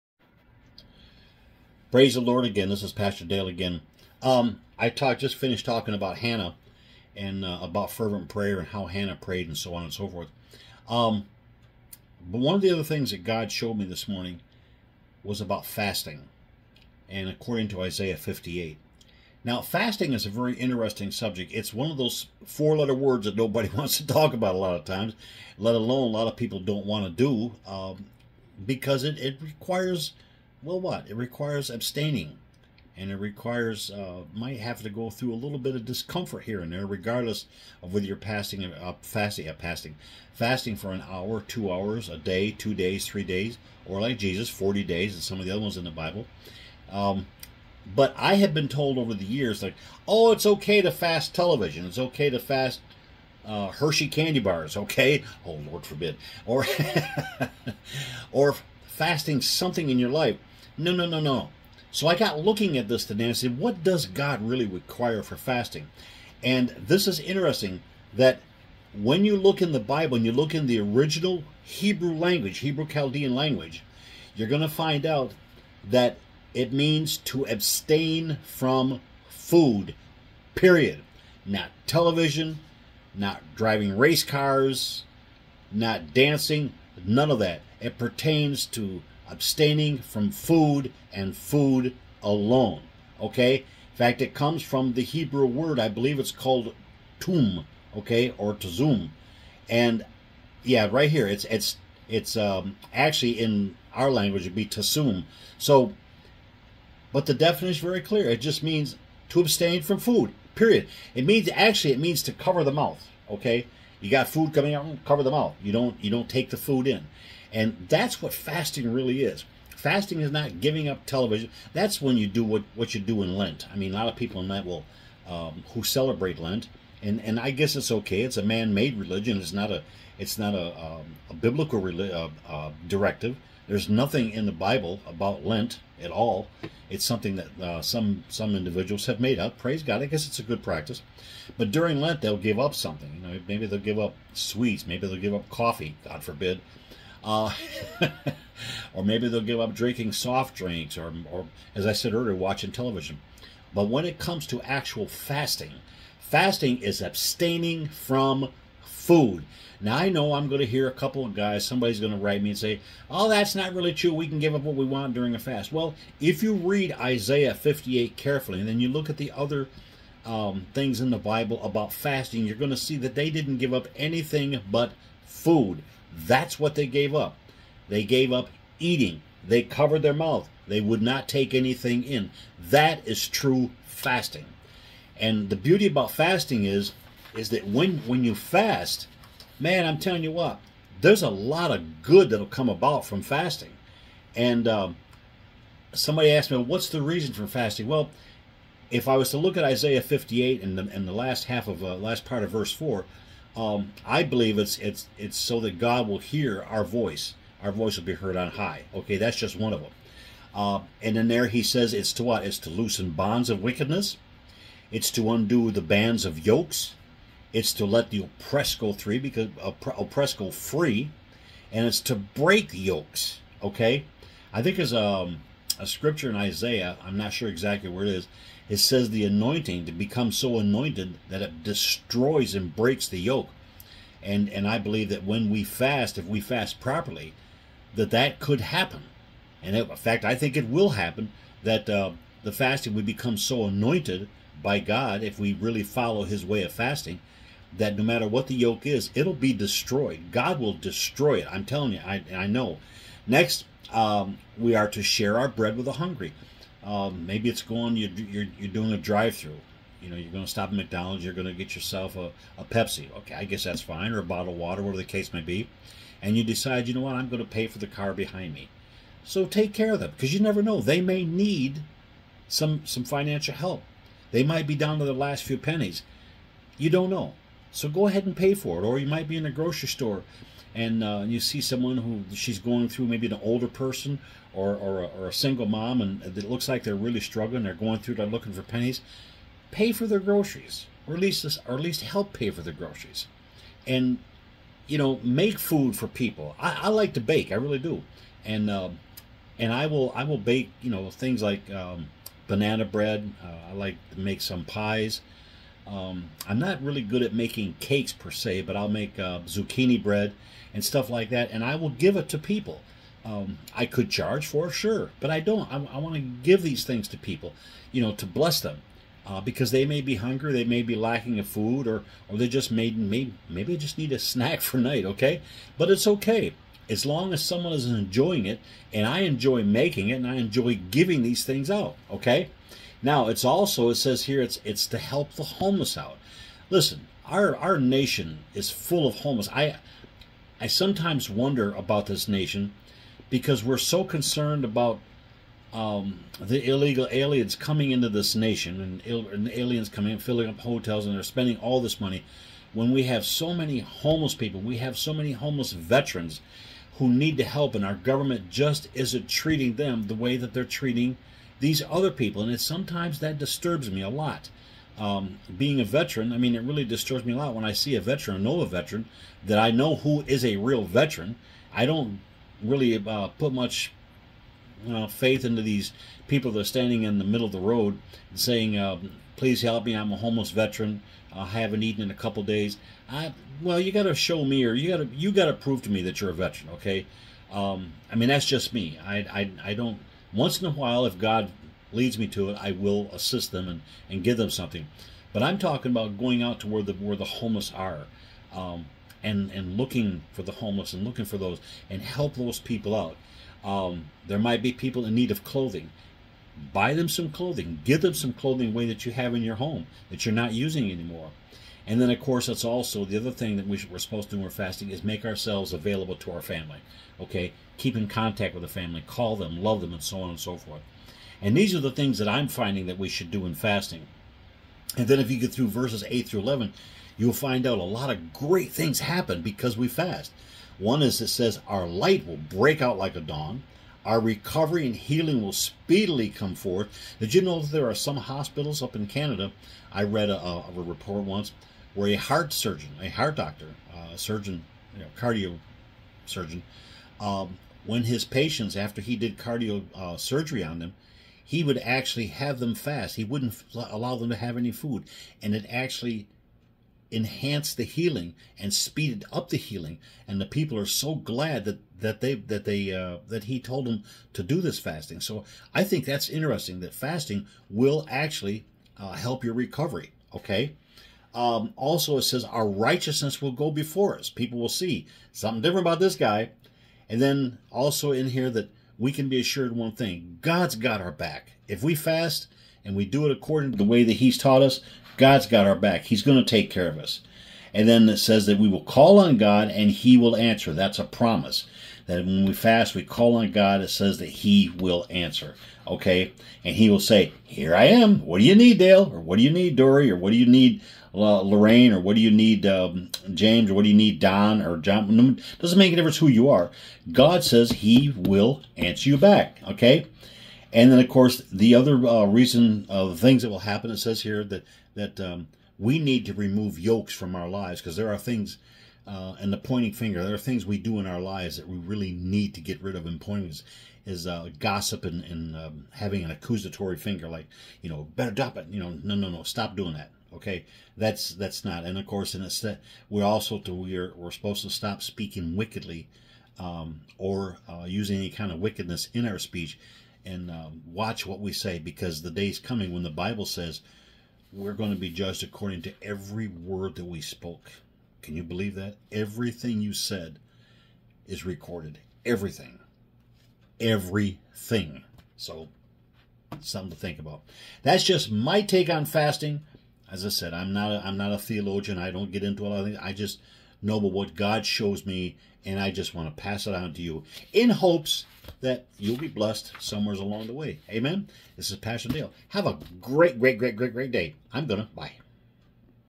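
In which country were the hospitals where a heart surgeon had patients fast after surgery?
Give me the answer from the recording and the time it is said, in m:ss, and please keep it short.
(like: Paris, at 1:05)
Canada, at 7:19.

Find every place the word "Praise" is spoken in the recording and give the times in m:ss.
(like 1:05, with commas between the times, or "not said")
0:01, 2:19.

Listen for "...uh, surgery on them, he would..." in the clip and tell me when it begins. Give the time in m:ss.
7:29.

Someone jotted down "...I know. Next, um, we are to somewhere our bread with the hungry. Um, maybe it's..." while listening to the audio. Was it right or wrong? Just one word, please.
wrong.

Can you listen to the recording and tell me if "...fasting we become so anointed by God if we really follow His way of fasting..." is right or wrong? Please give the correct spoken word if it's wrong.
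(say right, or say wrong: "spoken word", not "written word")
right.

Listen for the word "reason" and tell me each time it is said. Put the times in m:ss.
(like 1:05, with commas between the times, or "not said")
3:17, 8:32.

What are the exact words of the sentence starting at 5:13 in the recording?
Um, I could charge for sure, but I don't.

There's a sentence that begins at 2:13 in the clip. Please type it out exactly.
There's nothing in the Bible about Lent at all.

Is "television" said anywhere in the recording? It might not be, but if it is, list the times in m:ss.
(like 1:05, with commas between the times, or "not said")
0:51, 1:21, 2:01, 2:32.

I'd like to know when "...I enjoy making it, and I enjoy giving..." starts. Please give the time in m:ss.
5:29.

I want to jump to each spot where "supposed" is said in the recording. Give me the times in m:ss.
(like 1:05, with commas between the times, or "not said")
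6:53, 8:54.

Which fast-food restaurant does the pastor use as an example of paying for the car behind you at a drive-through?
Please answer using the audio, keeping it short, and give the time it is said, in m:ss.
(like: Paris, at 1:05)
McDonald's, at 4:20.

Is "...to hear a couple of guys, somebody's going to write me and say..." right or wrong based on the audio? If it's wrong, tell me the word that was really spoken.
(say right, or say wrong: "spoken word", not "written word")
right.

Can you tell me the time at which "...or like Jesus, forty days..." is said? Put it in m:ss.
0:43.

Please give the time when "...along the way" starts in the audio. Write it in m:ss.
9:30.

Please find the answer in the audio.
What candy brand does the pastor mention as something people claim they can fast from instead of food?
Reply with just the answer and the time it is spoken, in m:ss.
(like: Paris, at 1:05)
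Hershey, at 0:53.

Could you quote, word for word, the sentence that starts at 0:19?
Now, fasting is a very interesting subject.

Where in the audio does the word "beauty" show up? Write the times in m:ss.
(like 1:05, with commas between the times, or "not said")
3:05.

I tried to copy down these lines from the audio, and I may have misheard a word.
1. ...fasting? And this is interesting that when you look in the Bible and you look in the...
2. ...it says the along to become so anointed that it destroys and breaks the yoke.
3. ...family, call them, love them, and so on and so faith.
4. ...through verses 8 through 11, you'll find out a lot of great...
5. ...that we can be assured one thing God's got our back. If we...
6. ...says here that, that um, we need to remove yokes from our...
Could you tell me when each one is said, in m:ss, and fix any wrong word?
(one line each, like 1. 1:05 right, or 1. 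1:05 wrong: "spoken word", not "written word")
1. 1:05 right
2. 3:48 wrong: "anointing", not "along"
3. 6:58 wrong: "forth", not "faith"
4. 7:05 right
5. 7:58 right
6. 8:33 right.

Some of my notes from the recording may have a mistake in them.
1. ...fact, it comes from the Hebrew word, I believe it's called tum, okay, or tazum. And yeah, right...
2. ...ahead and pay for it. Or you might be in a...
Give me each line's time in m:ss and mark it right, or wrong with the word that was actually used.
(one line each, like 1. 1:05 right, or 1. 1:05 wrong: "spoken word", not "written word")
1. 1:33 right
2. 4:38 right.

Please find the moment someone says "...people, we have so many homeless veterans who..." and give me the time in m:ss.
5:54.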